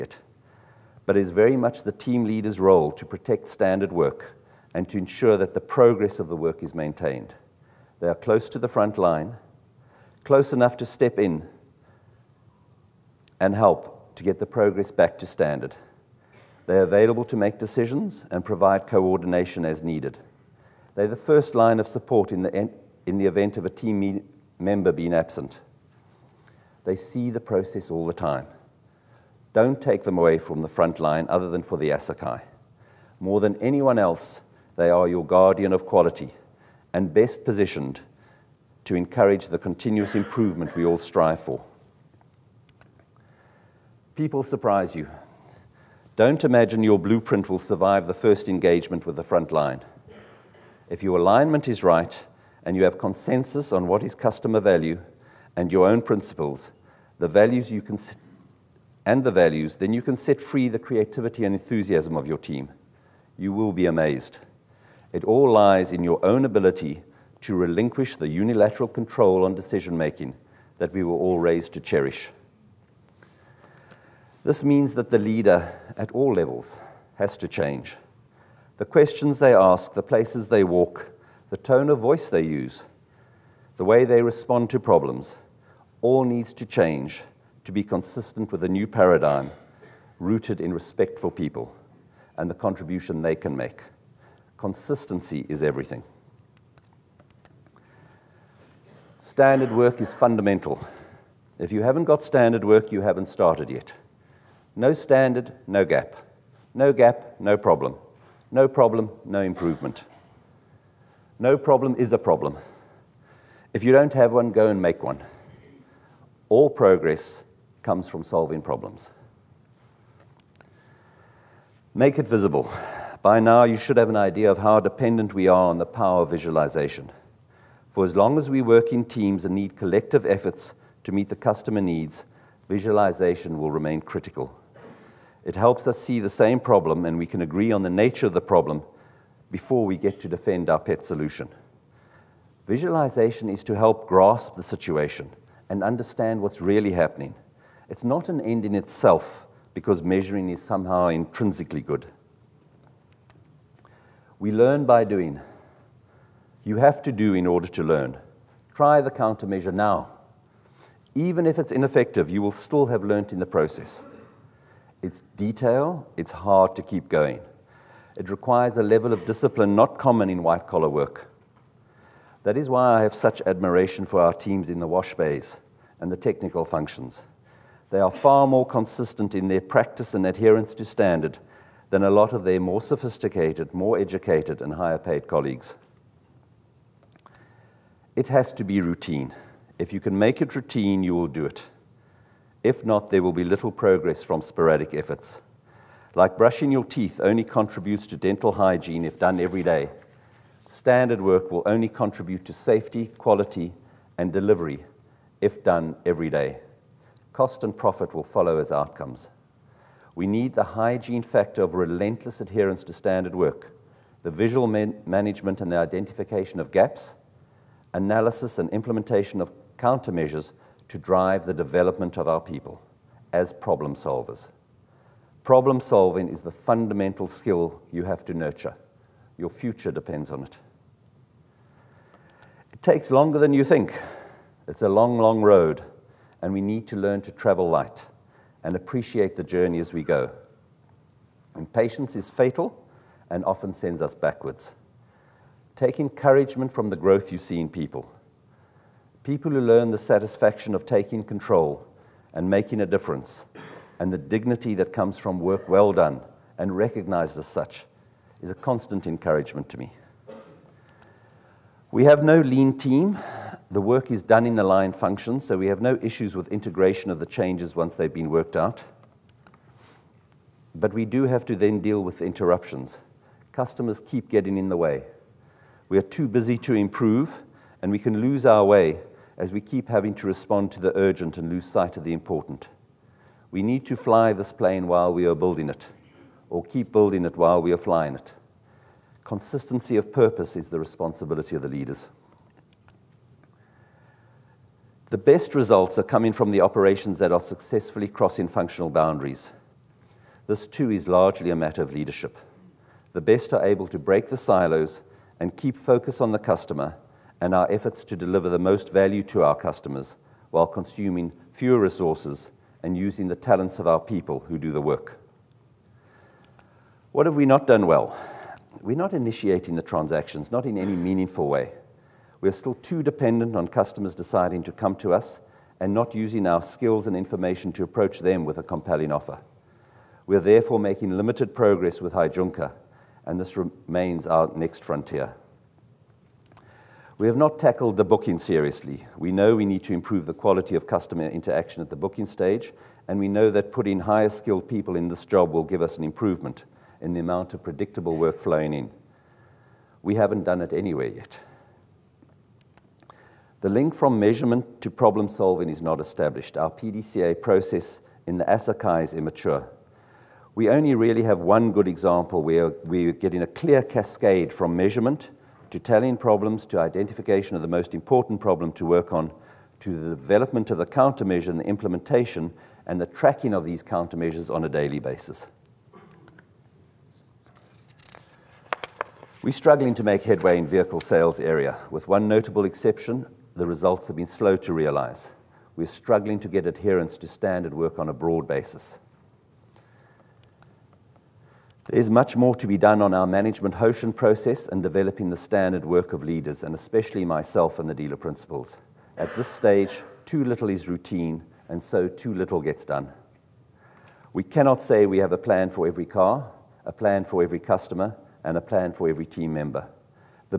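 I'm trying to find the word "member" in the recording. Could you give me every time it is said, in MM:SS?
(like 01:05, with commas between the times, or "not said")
00:24, 06:49.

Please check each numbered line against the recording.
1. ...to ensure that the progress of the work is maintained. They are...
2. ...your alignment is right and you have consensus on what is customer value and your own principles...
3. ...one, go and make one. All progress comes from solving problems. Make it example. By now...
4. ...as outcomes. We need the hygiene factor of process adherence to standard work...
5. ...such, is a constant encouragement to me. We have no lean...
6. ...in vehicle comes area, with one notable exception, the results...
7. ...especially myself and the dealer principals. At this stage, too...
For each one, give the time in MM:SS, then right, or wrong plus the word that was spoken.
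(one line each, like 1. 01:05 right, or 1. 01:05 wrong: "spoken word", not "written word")
1. 00:04 right
2. 00:51 right
3. 01:54 wrong: "visible", not "example"
4. 03:28 wrong: "relentless", not "process"
5. 04:17 right
6. 06:20 wrong: "sales", not "comes"
7. 06:36 right.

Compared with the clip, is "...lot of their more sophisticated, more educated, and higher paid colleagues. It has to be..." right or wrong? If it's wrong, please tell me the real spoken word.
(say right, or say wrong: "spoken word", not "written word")
right.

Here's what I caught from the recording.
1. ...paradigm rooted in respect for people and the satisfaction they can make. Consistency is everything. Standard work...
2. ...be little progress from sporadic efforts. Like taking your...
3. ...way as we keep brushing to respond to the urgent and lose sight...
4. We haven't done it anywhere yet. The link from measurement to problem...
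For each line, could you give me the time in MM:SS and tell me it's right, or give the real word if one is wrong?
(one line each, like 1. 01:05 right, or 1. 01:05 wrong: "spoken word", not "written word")
1. 01:28 wrong: "contribution", not "satisfaction"
2. 03:13 wrong: "brushing", not "taking"
3. 04:38 wrong: "having", not "brushing"
4. 05:50 right.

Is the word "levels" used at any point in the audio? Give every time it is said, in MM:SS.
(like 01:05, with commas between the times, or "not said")
01:16, 02:48.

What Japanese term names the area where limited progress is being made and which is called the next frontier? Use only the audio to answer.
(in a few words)
Heijunka.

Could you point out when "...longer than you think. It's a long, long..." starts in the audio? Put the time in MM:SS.
03:53.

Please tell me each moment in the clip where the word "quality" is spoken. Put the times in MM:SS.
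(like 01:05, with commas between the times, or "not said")
00:35, 03:23, 05:40.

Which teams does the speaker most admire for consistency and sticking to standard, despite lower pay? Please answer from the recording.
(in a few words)
wash bays.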